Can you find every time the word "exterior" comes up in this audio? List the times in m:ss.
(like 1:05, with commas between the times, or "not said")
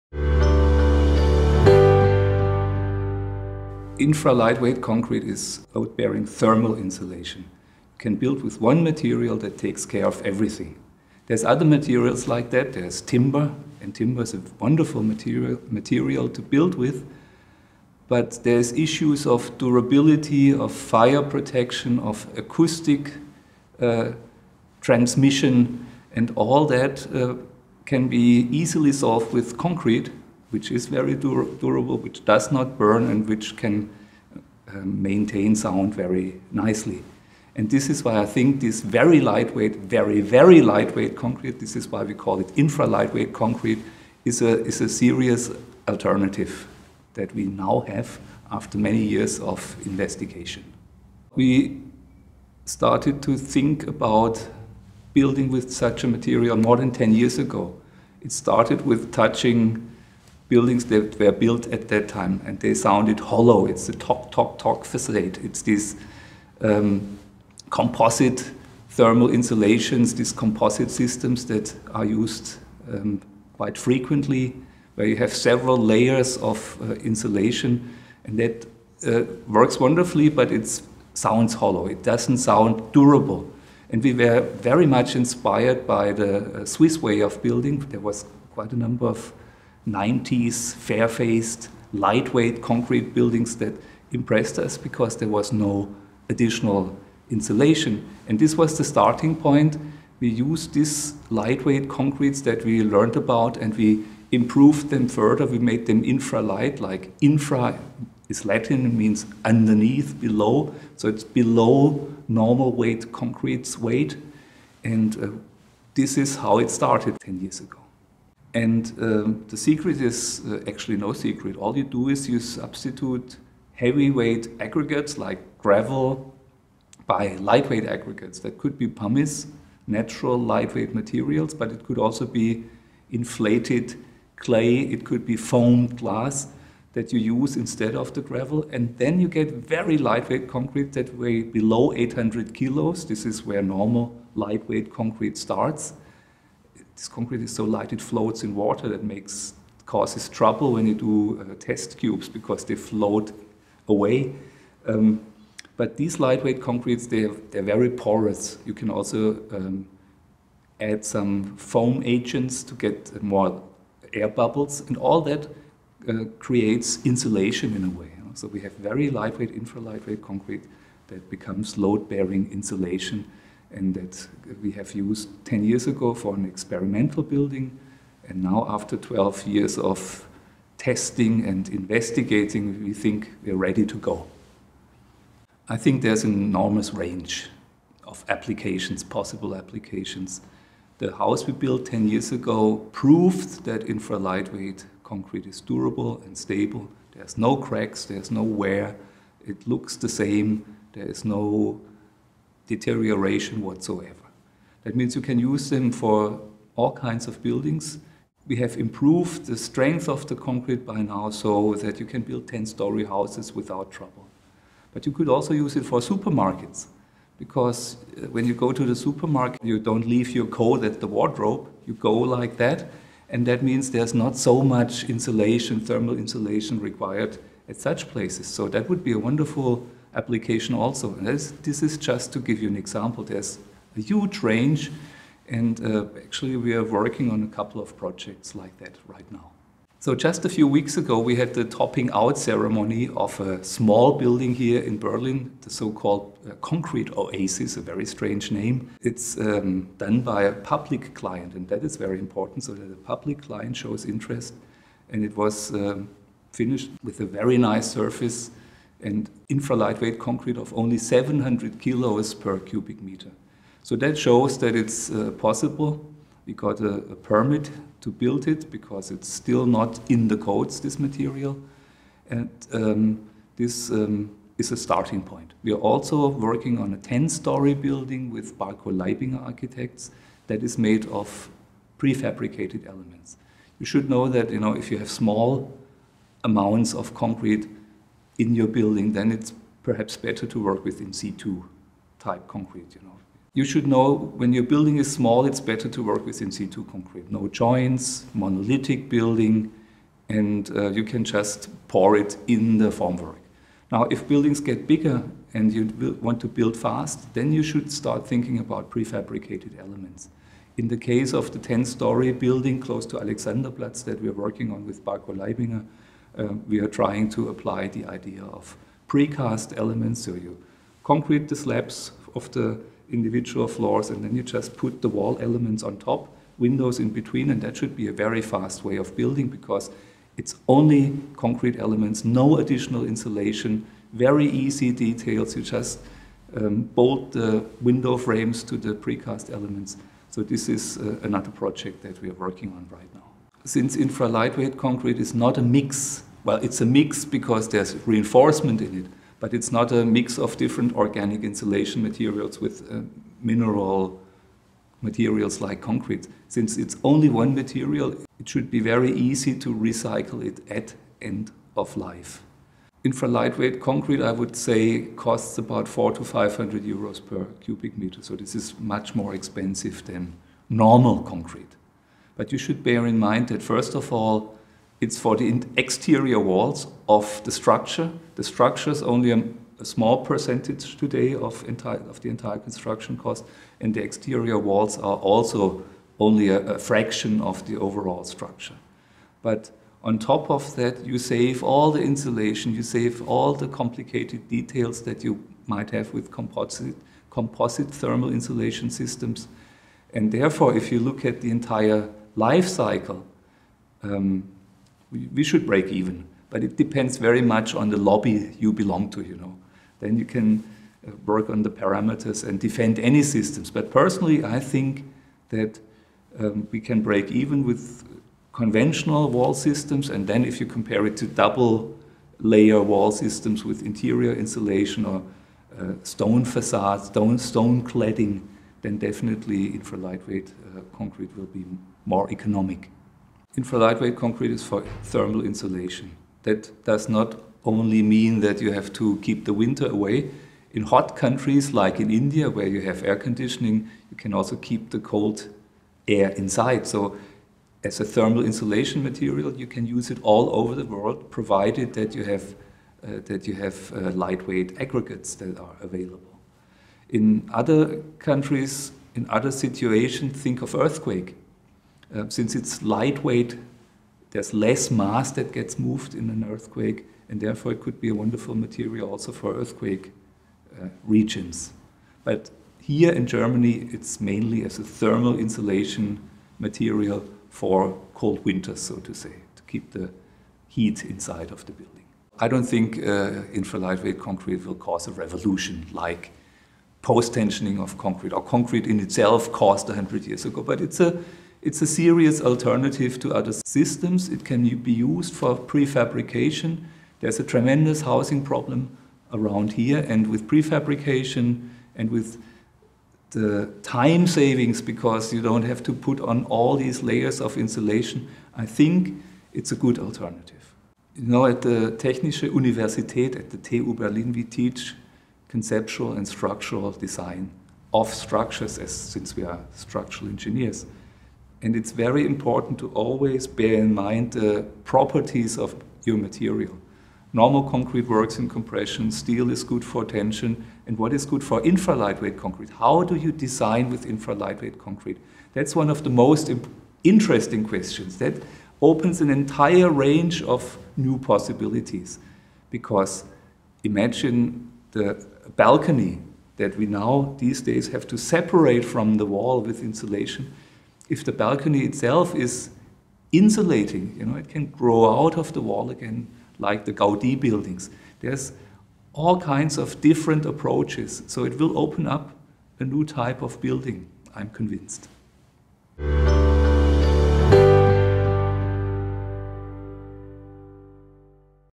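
6:15, 6:24.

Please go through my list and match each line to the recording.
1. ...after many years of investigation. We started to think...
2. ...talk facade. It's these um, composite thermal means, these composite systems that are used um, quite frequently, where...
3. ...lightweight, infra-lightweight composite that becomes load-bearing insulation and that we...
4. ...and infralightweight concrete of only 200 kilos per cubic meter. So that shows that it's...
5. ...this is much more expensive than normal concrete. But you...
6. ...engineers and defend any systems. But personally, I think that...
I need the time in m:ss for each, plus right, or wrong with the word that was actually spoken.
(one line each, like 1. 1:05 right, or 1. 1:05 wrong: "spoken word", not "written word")
1. 0:48 right
2. 1:04 wrong: "insulations", not "means"
3. 2:49 wrong: "concrete", not "composite"
4. 4:19 wrong: "700", not "200"
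5. 6:08 right
6. 6:51 wrong: "parameters", not "engineers".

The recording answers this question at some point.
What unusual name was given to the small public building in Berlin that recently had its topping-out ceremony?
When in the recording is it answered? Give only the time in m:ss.
4:06.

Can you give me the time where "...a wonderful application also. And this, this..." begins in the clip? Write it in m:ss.
3:49.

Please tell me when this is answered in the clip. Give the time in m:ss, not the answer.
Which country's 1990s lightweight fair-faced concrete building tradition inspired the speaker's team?
1:26.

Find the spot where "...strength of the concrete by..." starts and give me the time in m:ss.
3:29.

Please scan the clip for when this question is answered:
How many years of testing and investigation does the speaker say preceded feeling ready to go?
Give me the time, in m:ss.
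2:58.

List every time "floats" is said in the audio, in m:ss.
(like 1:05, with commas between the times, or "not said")
2:28, 2:32.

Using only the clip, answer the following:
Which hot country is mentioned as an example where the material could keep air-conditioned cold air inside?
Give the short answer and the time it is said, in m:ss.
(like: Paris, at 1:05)
India, at 7:22.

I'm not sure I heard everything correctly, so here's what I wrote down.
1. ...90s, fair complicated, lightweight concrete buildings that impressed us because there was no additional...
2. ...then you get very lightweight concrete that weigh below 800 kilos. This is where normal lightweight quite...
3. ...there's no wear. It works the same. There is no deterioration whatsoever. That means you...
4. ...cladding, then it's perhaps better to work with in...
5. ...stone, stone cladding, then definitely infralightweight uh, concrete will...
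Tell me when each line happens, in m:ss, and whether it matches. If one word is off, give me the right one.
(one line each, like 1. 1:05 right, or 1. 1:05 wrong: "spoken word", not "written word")
1. 1:29 wrong: "faced", not "complicated"
2. 2:18 wrong: "concrete", not "quite"
3. 3:18 wrong: "looks", not "works"
4. 4:48 wrong: "building", not "cladding"
5. 7:07 right.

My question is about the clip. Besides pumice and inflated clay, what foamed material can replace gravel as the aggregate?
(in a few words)
Foamed glass.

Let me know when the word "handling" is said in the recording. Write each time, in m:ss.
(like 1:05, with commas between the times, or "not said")
not said.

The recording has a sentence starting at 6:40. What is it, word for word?
And therefore, if you look at the entire life cycle, um, we, should break even.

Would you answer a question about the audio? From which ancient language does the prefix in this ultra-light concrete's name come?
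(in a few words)
Latin.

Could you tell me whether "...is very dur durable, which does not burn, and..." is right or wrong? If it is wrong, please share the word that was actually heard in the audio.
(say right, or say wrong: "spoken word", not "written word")
right.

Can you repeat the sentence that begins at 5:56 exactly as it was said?
Since it's only one material, it should be very easy to recycle it at end of life.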